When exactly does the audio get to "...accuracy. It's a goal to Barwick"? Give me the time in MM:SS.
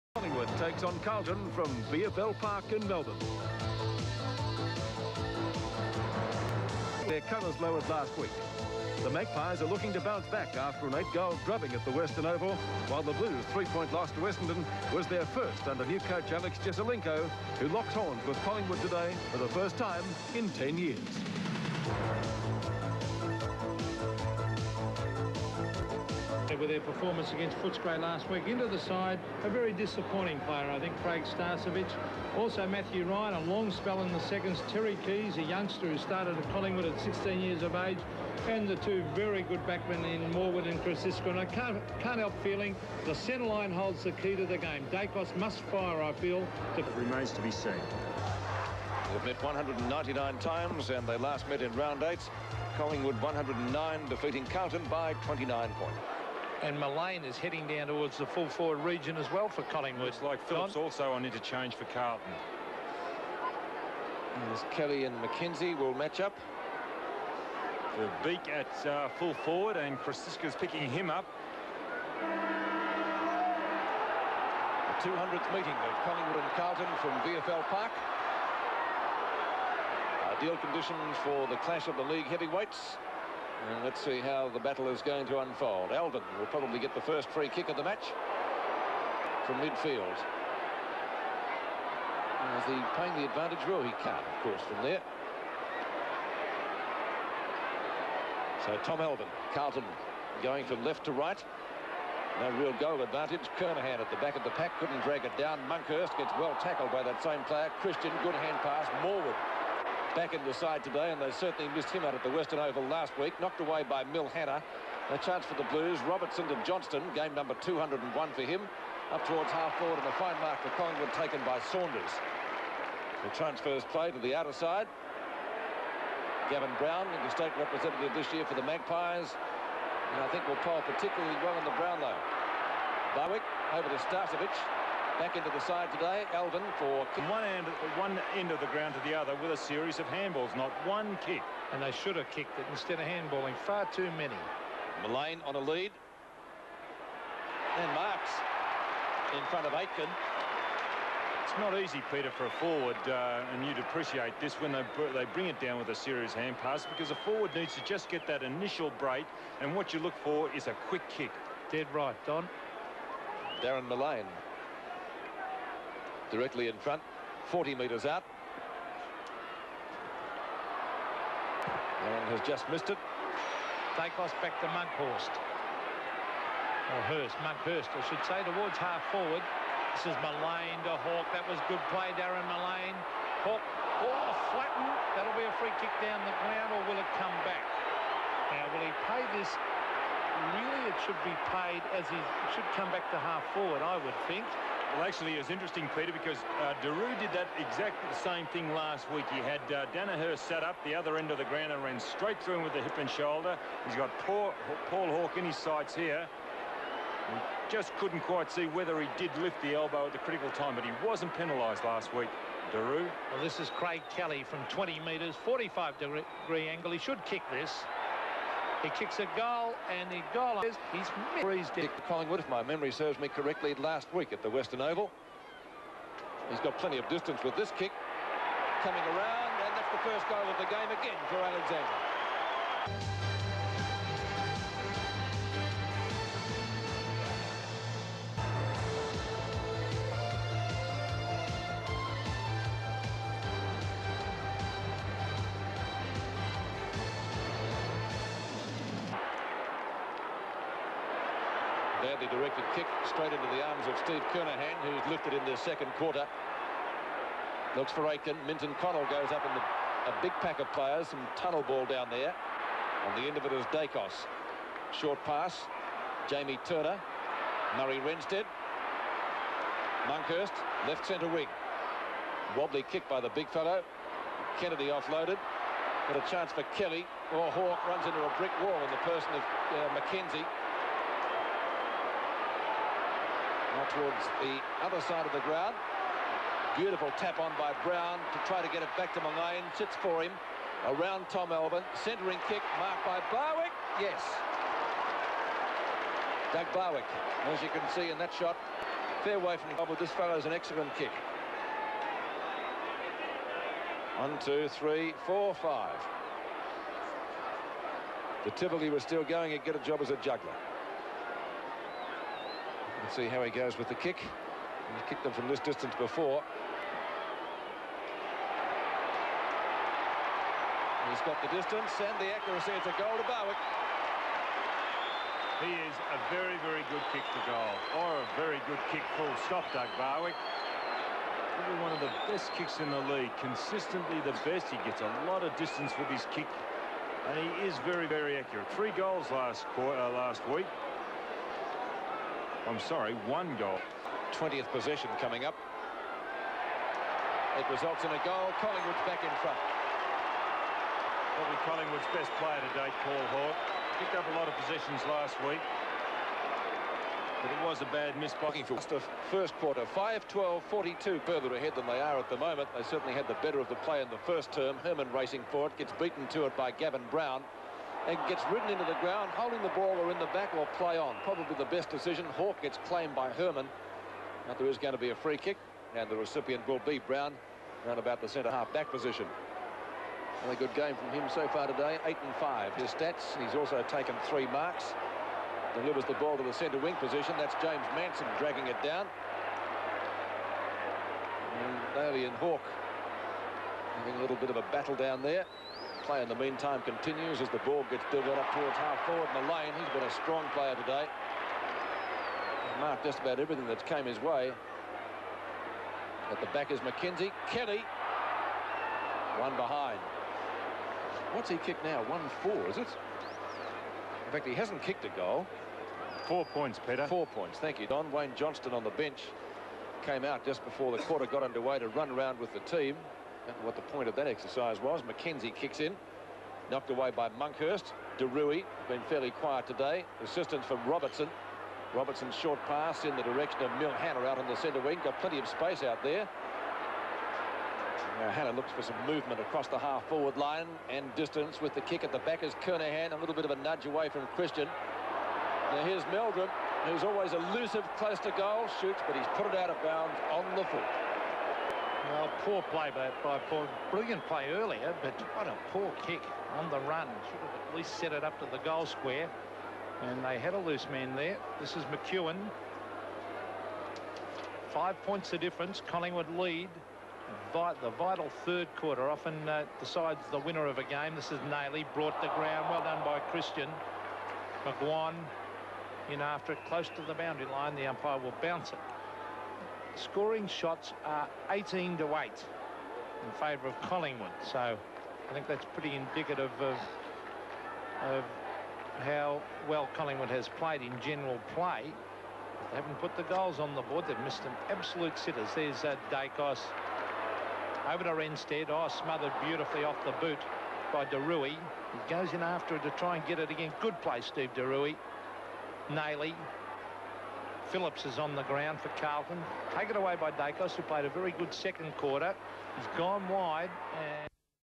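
05:22.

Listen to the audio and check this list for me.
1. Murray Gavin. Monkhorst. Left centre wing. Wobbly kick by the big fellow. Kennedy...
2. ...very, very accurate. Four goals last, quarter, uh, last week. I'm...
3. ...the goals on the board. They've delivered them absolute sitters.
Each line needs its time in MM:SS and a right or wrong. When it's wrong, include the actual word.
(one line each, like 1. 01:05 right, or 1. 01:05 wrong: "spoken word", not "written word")
1. 04:27 wrong: "Renstead", not "Gavin"
2. 05:37 wrong: "Three", not "Four"
3. 08:13 wrong: "missed", not "delivered".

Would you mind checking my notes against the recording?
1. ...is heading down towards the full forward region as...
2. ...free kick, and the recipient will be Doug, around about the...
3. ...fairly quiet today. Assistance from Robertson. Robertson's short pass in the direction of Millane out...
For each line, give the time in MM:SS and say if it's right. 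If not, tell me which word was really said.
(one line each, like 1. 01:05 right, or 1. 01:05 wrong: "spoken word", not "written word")
1. 00:57 right
2. 06:15 wrong: "Brown", not "Doug"
3. 07:09 right.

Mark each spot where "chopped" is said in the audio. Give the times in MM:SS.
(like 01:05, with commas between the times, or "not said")
not said.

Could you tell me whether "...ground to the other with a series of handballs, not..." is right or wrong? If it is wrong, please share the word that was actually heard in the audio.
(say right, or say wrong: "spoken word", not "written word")
right.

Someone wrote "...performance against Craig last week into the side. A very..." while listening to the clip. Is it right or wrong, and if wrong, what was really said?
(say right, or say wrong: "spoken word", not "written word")
wrong: "Footscray", not "Craig".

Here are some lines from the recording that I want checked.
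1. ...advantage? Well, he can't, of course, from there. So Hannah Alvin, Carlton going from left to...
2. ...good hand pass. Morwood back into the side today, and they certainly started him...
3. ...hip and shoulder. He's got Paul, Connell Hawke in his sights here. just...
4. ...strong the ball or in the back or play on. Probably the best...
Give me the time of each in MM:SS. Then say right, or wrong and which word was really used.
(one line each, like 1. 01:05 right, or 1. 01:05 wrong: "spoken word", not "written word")
1. 01:33 wrong: "Tom", not "Hannah"
2. 01:48 wrong: "missed", not "started"
3. 03:22 wrong: "Paul", not "Connell"
4. 06:09 wrong: "holding", not "strong".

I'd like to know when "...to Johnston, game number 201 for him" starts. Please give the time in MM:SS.
01:56.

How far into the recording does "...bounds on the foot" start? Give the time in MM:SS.
07:29.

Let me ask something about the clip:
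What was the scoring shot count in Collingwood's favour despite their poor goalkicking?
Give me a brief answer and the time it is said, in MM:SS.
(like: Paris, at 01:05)
18 to 8, at 08:01.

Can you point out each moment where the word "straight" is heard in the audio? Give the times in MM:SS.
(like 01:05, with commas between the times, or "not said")
03:21, 04:13.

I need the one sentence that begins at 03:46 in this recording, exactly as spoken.
He's got plenty of distance with this kick.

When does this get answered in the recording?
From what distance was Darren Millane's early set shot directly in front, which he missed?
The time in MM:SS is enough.
02:47.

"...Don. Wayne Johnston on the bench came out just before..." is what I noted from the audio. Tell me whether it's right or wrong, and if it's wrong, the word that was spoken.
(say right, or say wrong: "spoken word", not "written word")
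right.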